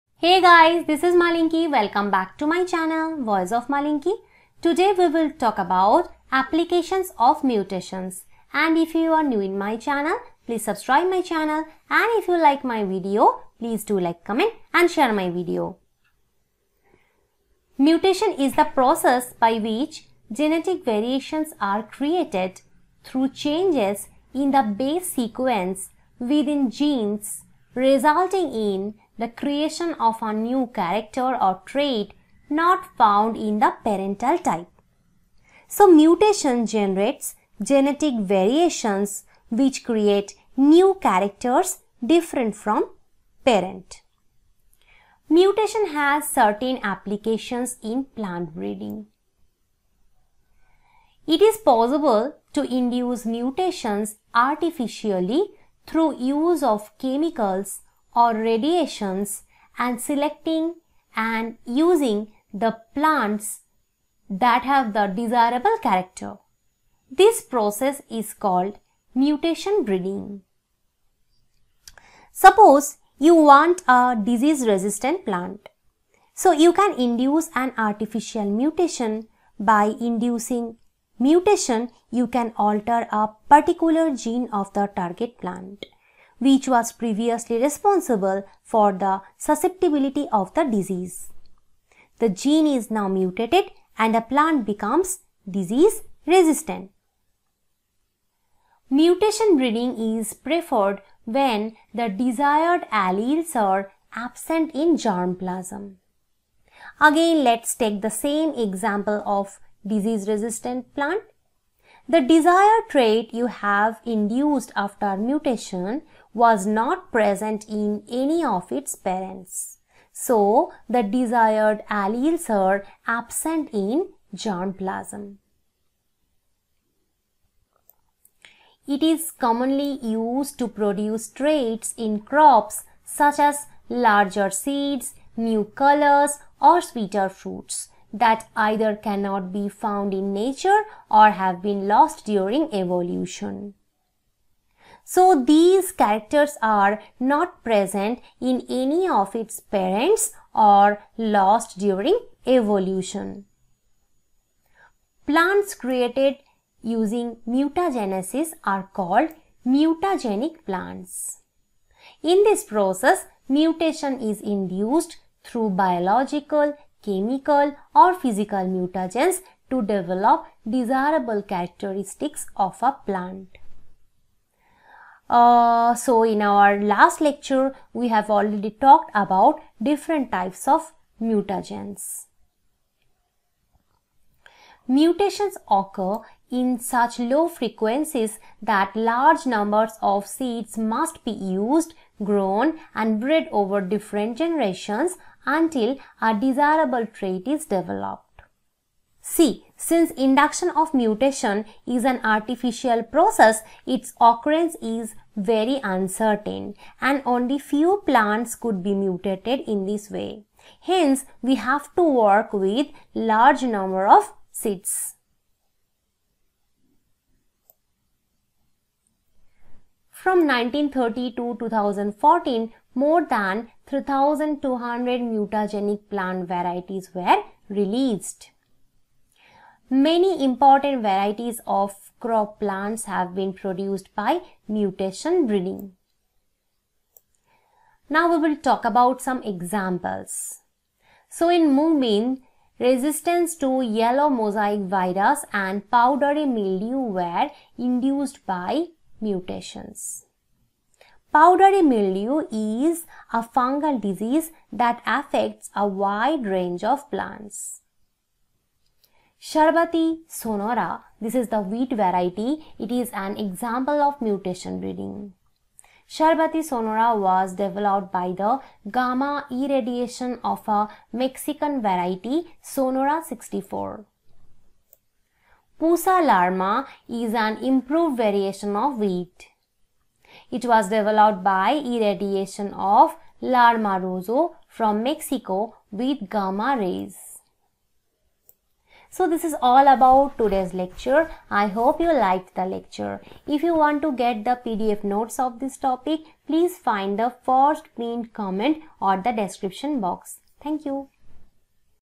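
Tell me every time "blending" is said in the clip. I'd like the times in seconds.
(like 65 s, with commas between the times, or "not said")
not said.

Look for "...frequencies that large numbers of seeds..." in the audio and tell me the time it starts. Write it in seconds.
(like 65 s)
187 s.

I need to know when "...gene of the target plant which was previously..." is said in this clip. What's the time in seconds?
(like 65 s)
84 s.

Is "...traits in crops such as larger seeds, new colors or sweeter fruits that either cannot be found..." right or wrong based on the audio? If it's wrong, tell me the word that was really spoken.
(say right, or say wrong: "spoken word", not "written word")
right.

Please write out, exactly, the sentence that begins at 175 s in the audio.
Uh, so in our last lecture, we have already talked about different types of mutagens.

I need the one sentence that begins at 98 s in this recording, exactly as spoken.
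Mutation breeding is preferred when the desired alleles are absent in germplasm.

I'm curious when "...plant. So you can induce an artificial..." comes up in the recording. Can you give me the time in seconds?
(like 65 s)
75 s.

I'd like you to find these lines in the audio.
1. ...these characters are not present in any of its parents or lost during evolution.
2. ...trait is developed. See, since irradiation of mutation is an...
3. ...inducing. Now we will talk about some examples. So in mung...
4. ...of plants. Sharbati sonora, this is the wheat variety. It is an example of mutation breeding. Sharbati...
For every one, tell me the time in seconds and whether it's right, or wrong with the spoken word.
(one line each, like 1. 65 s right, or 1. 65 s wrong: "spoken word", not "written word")
1. 145 s right
2. 197 s wrong: "induction", not "irradiation"
3. 235 s wrong: "breeding", not "inducing"
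4. 256 s right.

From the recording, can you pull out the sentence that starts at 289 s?
So this is all about today's lecture.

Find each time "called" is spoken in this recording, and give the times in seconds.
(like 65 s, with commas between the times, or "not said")
68 s, 159 s.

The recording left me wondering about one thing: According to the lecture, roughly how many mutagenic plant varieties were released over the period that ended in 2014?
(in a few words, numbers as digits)
More than 3200.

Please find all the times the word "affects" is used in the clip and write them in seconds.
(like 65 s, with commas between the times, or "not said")
255 s.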